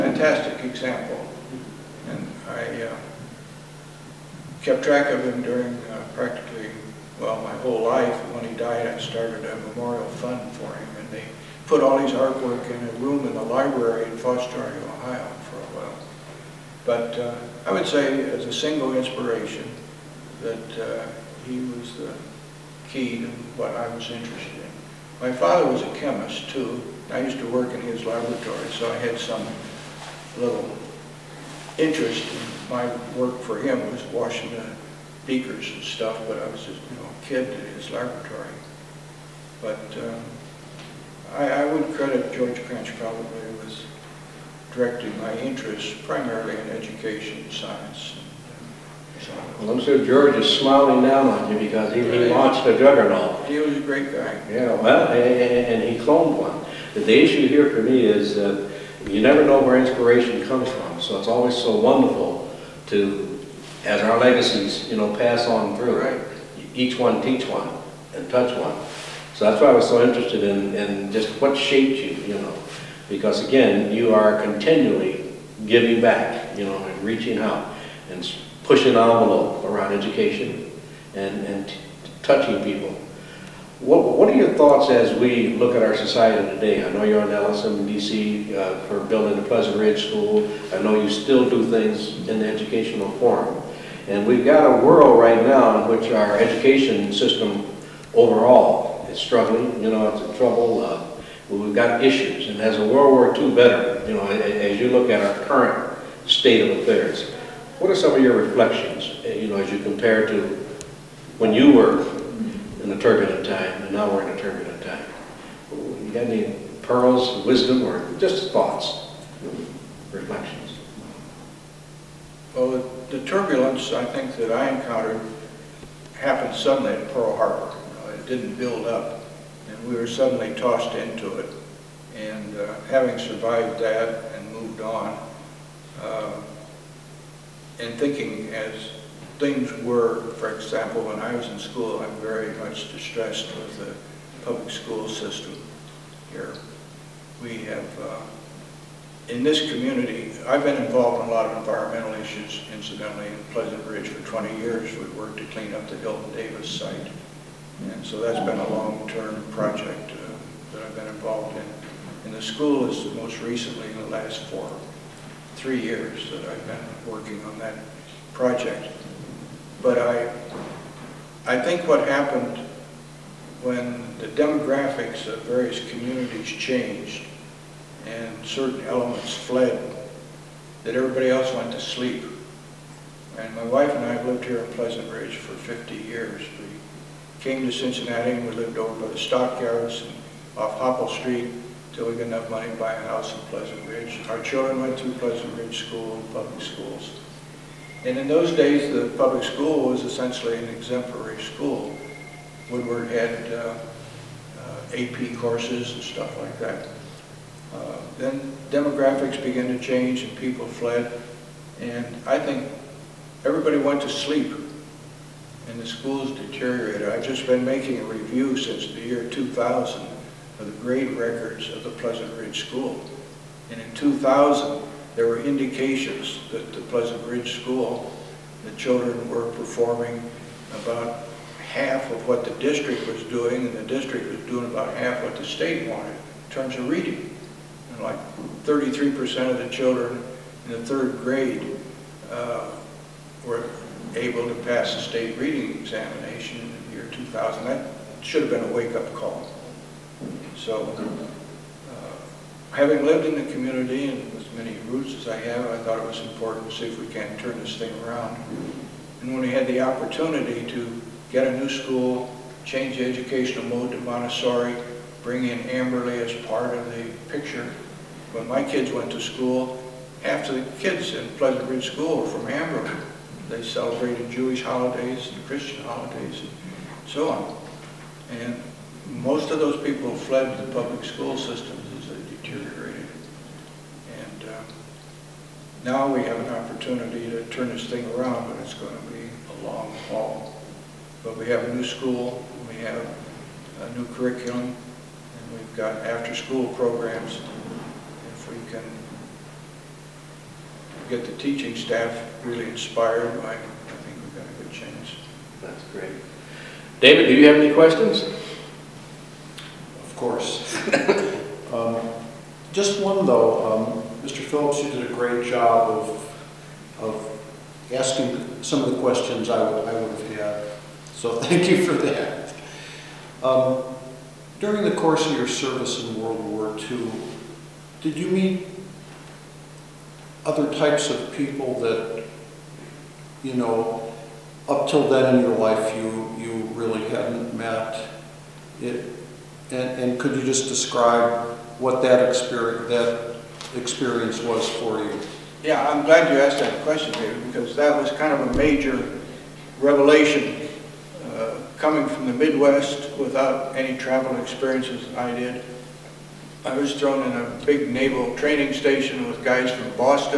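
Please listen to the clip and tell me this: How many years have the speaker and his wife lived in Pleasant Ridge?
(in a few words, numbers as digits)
50.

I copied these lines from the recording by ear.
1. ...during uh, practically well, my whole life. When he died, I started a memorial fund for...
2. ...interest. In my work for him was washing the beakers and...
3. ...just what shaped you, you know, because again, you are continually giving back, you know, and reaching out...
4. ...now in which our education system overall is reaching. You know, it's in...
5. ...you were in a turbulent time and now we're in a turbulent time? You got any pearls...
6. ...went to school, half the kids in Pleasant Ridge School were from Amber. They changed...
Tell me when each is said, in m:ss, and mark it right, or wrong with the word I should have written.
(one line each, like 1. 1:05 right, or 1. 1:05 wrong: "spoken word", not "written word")
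1. 0:05 right
2. 0:31 right
3. 1:11 right
4. 1:35 wrong: "struggling", not "reaching"
5. 1:51 right
6. 4:28 wrong: "celebrated", not "changed".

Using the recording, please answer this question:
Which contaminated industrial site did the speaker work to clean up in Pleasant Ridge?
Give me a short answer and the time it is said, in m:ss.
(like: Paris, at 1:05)
Hilton Davis site, at 2:35.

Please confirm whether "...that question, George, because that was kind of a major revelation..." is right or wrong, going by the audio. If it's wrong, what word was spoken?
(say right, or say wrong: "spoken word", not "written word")
wrong: "David", not "George".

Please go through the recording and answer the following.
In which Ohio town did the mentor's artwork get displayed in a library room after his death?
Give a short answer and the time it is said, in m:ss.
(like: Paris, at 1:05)
Foster, at 0:14.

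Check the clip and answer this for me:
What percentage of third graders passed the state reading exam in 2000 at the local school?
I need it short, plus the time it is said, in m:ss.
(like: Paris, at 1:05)
33%, at 3:58.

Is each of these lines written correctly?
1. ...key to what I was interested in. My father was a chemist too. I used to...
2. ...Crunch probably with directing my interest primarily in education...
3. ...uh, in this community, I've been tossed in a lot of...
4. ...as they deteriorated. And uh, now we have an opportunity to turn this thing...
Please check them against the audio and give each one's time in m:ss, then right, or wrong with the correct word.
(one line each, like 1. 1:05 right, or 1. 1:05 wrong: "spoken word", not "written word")
1. 0:22 right
2. 0:42 right
3. 2:28 wrong: "involved", not "tossed"
4. 4:41 right.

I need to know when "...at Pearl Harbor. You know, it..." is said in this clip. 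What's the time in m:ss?
2:06.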